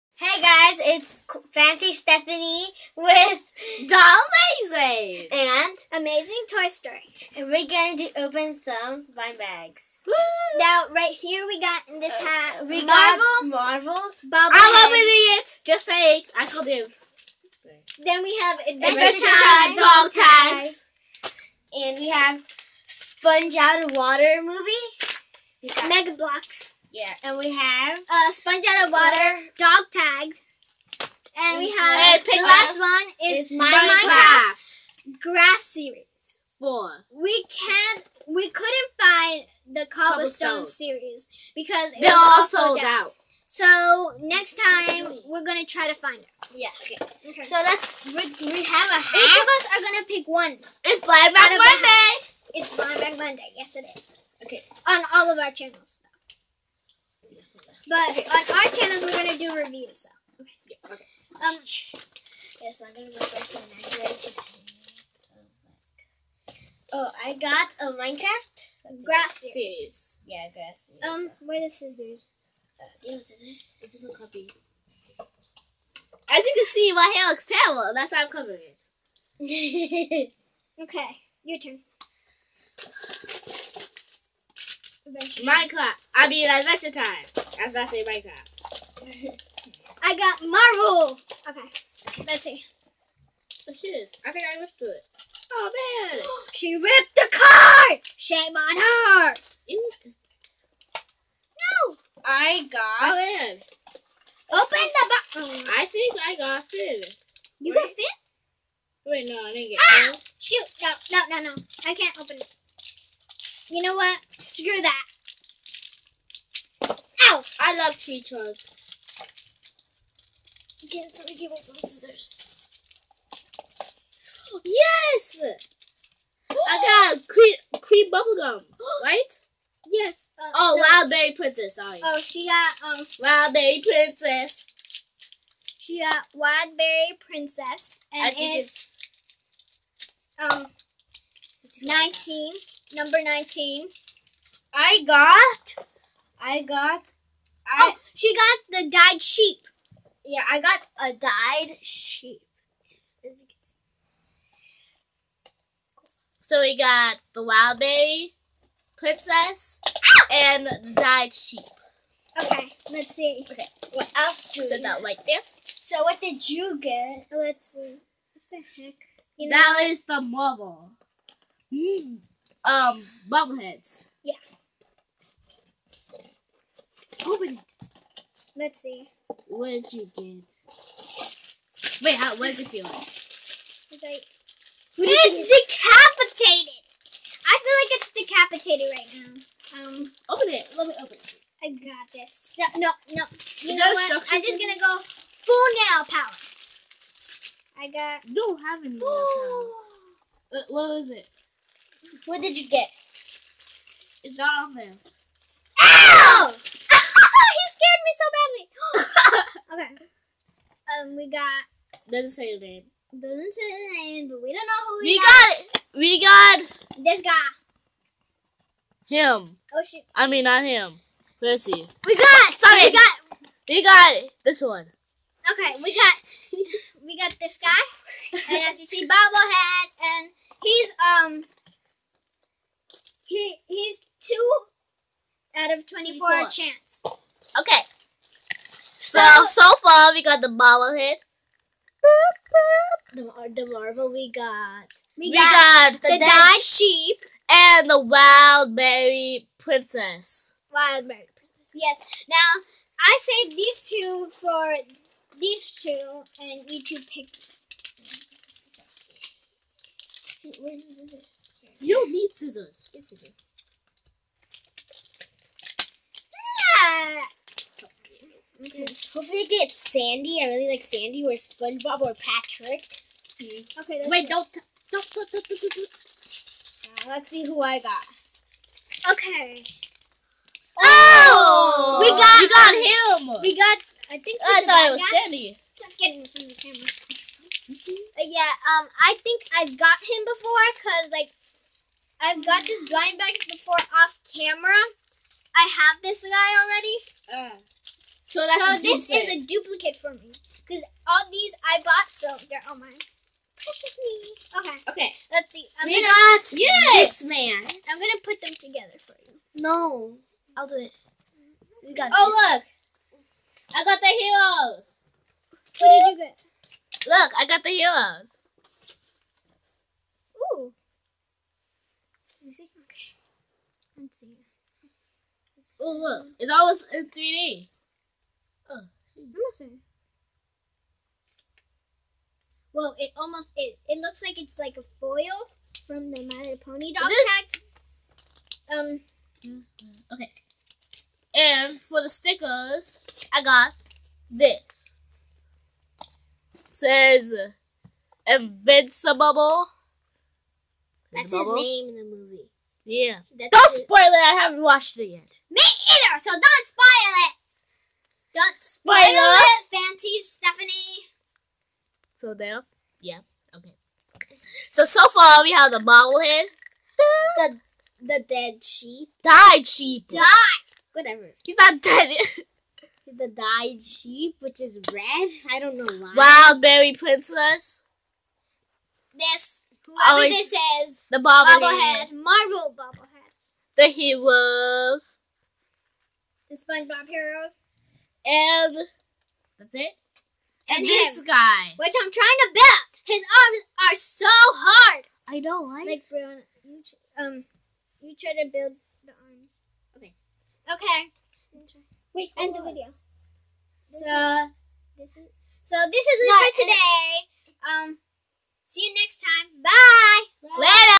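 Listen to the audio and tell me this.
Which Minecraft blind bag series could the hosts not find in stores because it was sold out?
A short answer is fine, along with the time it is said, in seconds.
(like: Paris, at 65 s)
Cobblestone series, at 39 s.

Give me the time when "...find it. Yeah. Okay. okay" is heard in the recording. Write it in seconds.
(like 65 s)
45 s.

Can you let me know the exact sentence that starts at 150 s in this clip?
Yeah, I got a dyed sheep.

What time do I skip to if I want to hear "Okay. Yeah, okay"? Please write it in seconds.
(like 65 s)
60 s.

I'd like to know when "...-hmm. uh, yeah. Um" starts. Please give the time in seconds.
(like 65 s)
287 s.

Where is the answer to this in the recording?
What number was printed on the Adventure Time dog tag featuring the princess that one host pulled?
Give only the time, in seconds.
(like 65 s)
142 s.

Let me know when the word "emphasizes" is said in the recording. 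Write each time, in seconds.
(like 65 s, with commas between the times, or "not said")
not said.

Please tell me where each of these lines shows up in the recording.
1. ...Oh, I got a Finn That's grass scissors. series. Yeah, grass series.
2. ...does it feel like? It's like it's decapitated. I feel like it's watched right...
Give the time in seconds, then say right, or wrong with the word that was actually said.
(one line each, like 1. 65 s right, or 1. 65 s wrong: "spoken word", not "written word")
1. 66 s wrong: "Minecraft", not "Finn"
2. 182 s wrong: "decapitated", not "watched".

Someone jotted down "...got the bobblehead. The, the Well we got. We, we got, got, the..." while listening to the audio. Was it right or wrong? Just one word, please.
wrong.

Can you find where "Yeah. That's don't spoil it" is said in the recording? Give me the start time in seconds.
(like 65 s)
352 s.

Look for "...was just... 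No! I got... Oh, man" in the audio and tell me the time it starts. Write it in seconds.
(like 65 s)
99 s.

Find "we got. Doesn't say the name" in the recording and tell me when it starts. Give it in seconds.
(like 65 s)
211 s.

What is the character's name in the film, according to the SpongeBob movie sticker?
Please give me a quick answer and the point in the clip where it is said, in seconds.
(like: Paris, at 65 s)
Invincible, at 348 s.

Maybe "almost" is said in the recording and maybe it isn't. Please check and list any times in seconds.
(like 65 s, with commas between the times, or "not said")
326 s, 333 s.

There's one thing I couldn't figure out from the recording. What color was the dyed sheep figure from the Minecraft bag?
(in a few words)
Red.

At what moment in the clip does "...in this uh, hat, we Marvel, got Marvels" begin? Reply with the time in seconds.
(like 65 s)
11 s.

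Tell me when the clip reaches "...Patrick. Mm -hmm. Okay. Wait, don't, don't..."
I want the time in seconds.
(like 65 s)
272 s.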